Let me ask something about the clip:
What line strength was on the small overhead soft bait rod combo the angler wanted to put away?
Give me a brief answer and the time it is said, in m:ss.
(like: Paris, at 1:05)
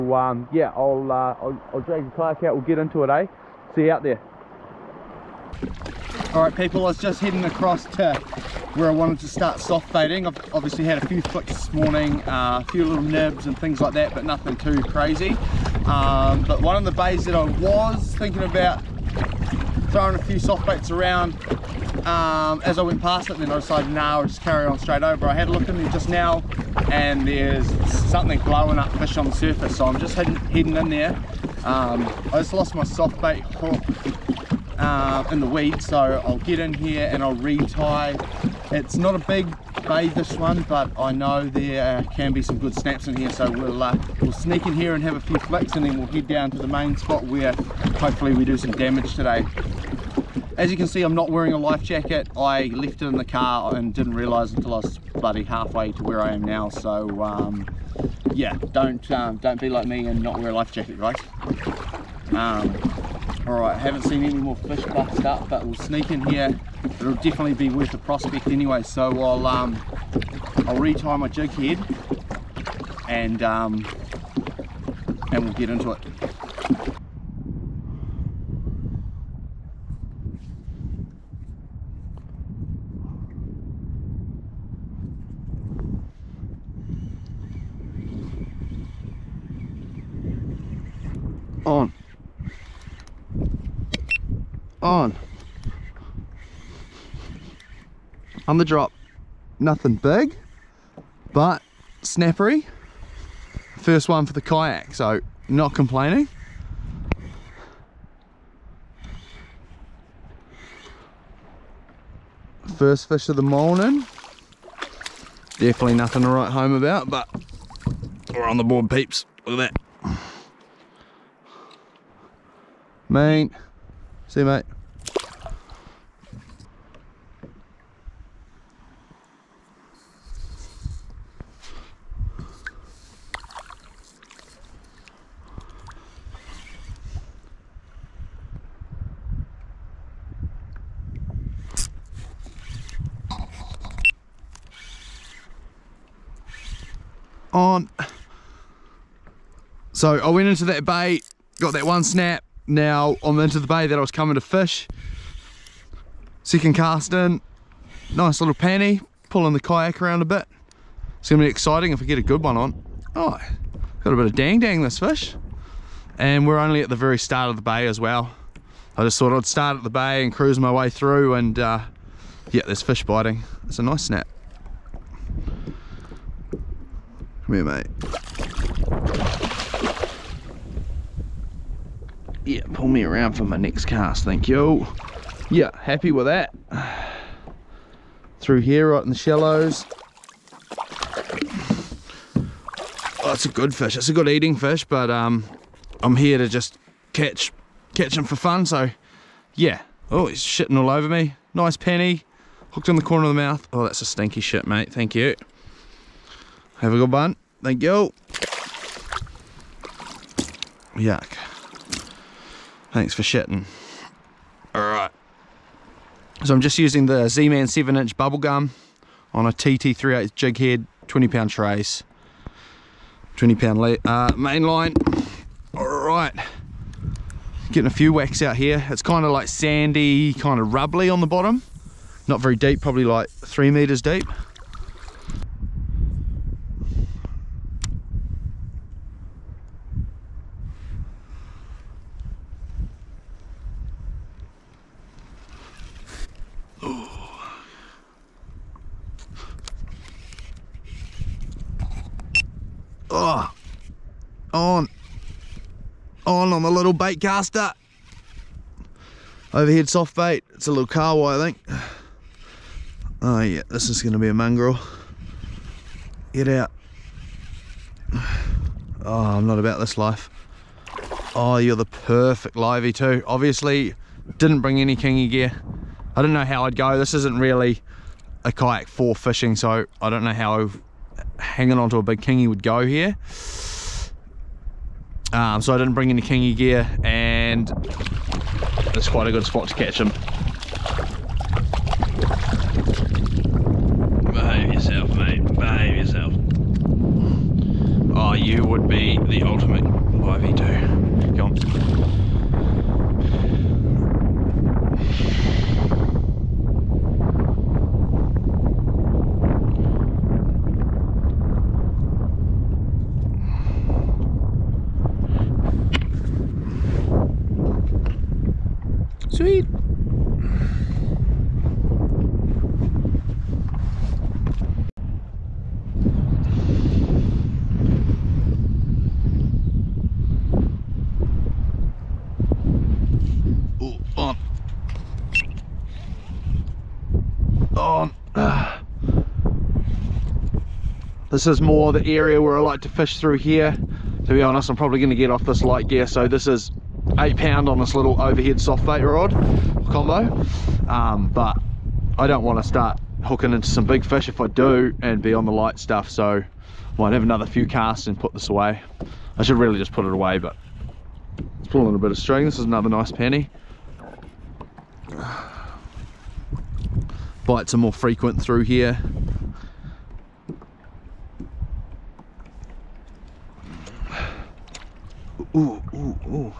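8 pound, at 5:47.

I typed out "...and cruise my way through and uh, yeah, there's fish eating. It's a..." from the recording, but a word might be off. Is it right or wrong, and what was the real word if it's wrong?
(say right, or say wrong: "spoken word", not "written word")
wrong: "biting", not "eating".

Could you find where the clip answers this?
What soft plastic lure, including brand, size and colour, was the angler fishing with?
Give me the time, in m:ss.
3:37.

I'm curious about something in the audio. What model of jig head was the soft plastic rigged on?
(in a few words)
TT38.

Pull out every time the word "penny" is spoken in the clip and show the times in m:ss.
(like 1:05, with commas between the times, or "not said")
3:21, 6:03.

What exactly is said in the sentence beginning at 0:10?
I've obviously had a few flicks this morning, uh, a few little nibs and things like that, but nothing too crazy.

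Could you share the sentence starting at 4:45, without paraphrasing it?
Um, so I didn't bring any kingy gear and it's quite a good spot to catch them.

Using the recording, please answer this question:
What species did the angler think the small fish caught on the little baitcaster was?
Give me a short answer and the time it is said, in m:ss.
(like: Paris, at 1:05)
kahawai, at 4:20.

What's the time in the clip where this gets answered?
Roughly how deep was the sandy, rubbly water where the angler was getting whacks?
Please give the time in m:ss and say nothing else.
3:53.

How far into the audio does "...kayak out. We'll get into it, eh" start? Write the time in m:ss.
0:02.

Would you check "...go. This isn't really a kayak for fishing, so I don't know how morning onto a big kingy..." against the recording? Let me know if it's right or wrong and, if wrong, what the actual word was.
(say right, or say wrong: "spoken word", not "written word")
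wrong: "hanging", not "morning".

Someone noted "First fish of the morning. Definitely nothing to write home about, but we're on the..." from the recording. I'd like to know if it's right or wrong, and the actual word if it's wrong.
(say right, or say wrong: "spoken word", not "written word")
right.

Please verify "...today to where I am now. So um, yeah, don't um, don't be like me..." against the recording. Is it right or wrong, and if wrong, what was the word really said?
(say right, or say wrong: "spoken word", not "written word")
wrong: "halfway", not "today".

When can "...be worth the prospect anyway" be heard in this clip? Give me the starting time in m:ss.
1:07.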